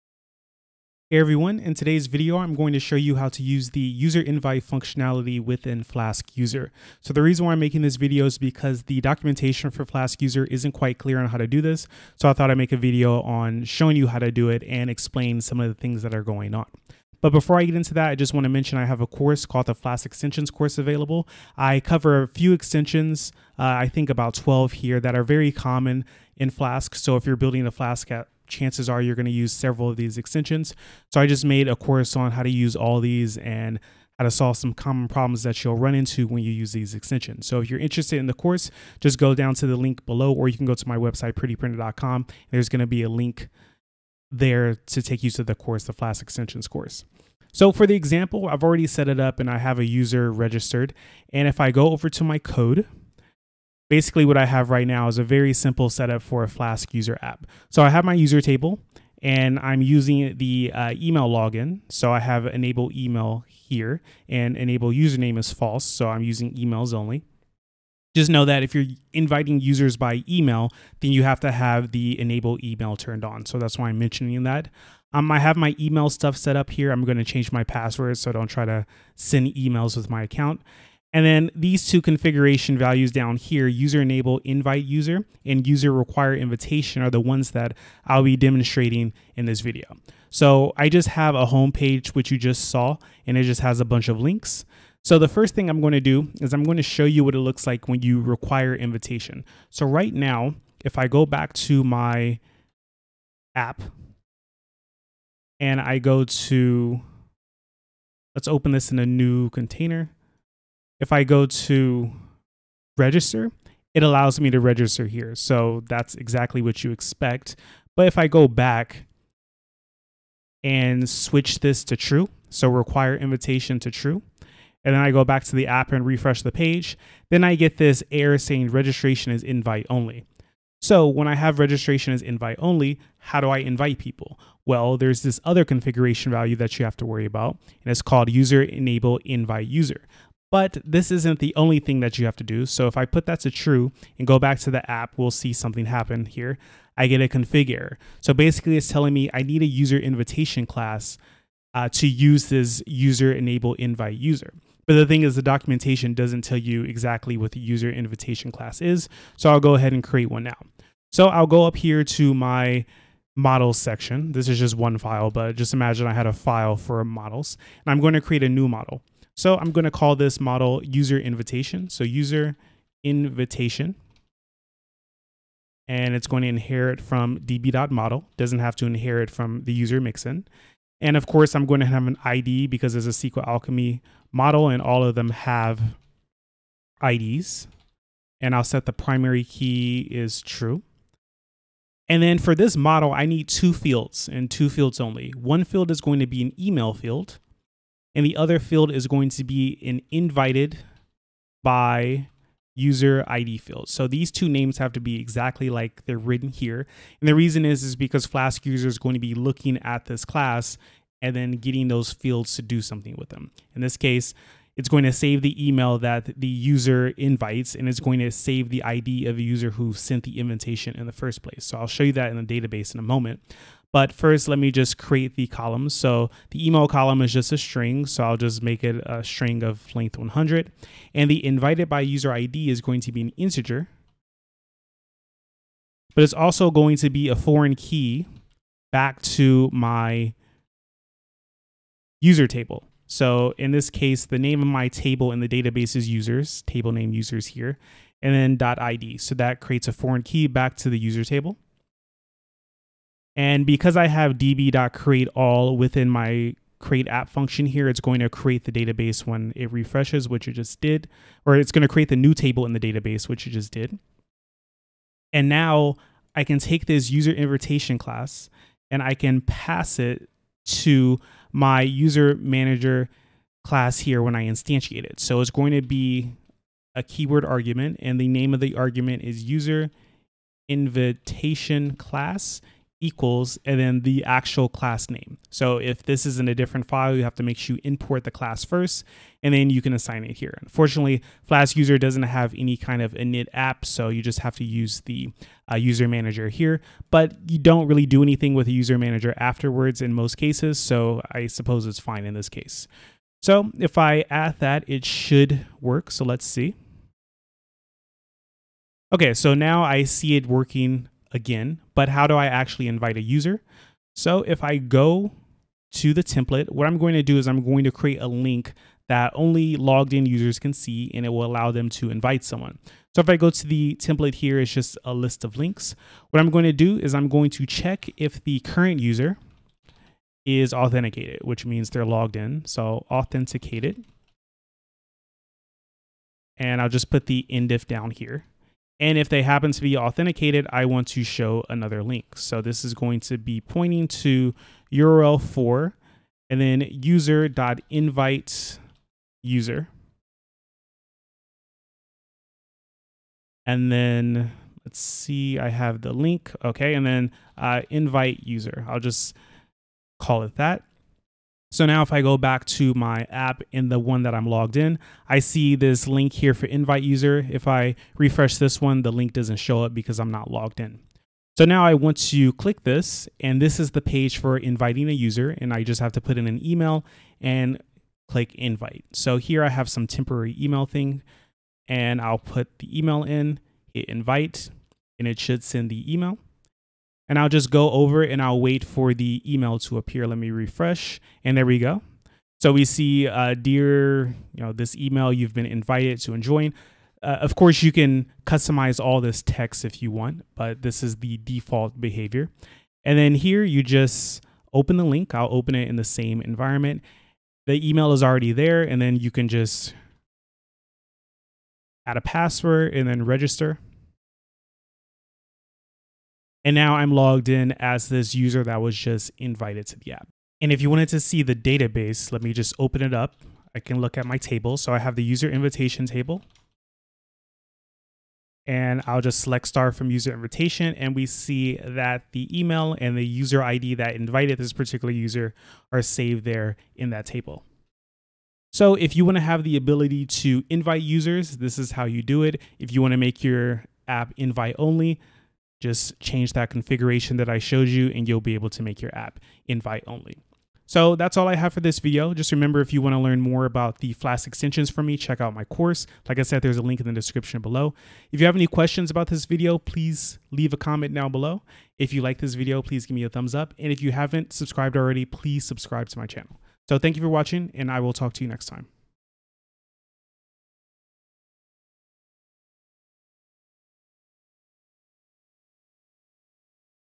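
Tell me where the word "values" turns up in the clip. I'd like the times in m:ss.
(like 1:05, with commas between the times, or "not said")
1:22, 2:16.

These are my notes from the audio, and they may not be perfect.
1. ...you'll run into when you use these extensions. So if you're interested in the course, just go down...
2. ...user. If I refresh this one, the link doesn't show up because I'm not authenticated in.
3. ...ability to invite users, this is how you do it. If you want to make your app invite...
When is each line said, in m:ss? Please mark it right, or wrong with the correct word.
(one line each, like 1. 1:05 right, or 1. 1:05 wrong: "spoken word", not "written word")
1. 0:35 right
2. 6:07 wrong: "logged", not "authenticated"
3. 7:19 right.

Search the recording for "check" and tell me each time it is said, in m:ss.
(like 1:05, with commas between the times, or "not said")
5:27, 7:35.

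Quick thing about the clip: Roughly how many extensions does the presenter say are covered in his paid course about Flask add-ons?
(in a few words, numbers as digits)
12.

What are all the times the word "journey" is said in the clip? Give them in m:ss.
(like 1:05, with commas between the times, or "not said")
not said.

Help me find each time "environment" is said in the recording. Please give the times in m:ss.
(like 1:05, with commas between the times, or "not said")
6:46.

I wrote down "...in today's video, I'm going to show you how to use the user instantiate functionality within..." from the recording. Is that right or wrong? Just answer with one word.
wrong.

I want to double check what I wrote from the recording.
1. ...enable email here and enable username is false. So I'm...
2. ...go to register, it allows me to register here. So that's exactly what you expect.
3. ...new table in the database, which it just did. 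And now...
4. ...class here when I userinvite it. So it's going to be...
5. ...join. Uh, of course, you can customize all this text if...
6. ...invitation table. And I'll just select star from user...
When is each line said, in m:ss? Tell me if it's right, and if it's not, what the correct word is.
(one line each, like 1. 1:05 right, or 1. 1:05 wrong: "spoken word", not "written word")
1. 1:02 right
2. 1:51 right
3. 4:22 right
4. 4:33 wrong: "instantiate", not "userinvite"
5. 6:36 right
6. 7:05 right.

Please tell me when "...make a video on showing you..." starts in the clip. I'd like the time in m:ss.
0:12.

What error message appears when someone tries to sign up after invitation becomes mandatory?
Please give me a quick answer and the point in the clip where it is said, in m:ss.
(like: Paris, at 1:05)
Registration is invite only, at 2:08.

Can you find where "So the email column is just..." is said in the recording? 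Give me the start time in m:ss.
3:45.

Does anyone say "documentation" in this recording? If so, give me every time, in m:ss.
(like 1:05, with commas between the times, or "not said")
0:09, 2:35.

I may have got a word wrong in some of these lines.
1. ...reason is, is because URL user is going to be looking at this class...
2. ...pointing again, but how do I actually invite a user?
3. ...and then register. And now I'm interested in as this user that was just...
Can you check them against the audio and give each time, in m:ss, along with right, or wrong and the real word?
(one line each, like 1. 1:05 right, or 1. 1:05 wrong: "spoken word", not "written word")
1. 3:27 wrong: "Flask", not "URL"
2. 5:10 wrong: "working", not "pointing"
3. 6:52 wrong: "logged", not "interested".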